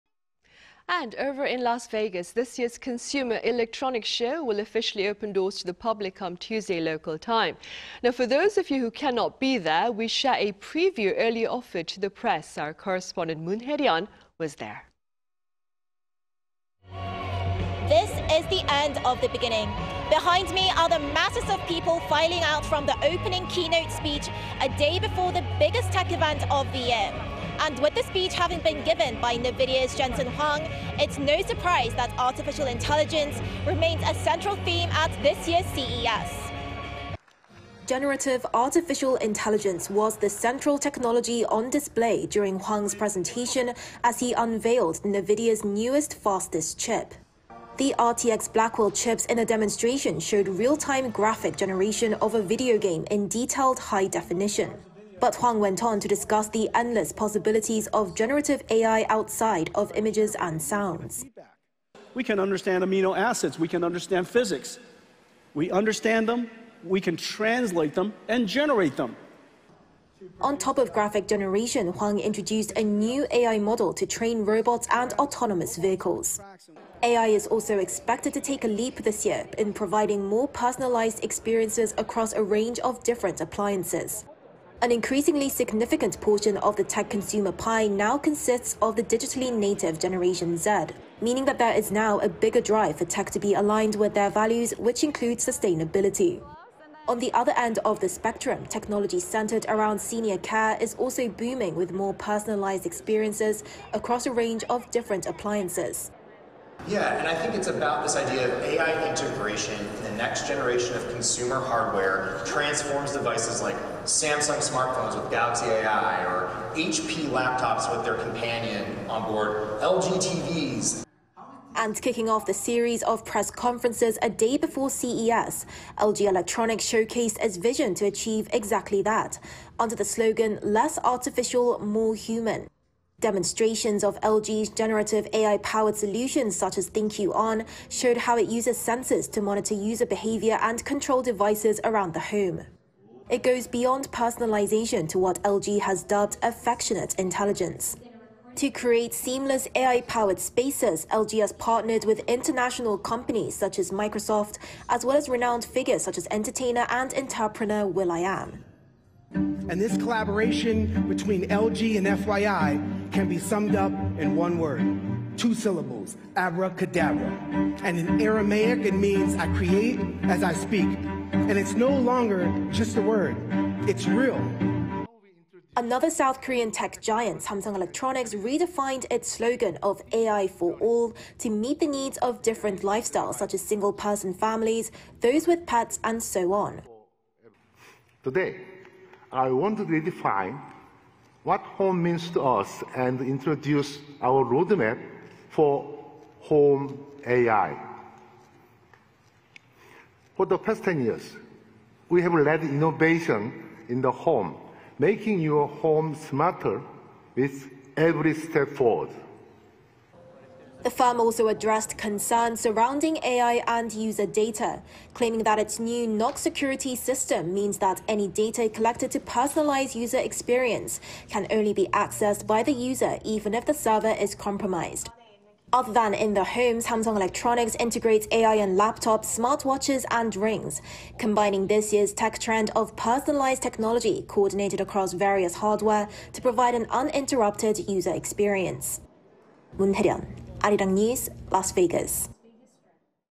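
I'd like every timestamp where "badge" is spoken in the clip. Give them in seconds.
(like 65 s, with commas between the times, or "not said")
not said.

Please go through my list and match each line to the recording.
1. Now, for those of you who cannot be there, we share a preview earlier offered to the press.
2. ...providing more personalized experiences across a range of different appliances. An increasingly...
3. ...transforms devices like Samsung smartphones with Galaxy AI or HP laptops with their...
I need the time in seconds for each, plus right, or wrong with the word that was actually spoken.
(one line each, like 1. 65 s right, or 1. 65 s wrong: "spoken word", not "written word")
1. 8 s right
2. 79 s right
3. 112 s right.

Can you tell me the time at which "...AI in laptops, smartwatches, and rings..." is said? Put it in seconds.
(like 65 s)
228 s.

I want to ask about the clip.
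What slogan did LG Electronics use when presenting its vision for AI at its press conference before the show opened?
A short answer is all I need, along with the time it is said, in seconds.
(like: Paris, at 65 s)
Less Artificial, More Human, at 130 s.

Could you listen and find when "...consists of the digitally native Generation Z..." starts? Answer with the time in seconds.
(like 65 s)
88 s.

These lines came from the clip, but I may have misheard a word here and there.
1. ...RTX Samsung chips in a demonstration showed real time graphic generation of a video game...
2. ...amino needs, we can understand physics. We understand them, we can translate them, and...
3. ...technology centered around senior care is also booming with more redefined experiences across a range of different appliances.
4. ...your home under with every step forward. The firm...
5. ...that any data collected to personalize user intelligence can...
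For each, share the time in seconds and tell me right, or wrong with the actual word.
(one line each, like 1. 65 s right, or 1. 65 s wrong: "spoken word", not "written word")
1. 47 s wrong: "Blackwell", not "Samsung"
2. 62 s wrong: "acids", not "needs"
3. 98 s wrong: "personalized", not "redefined"
4. 205 s wrong: "smarter", not "under"
5. 217 s wrong: "experience", not "intelligence".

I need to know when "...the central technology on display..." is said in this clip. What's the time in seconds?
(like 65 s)
40 s.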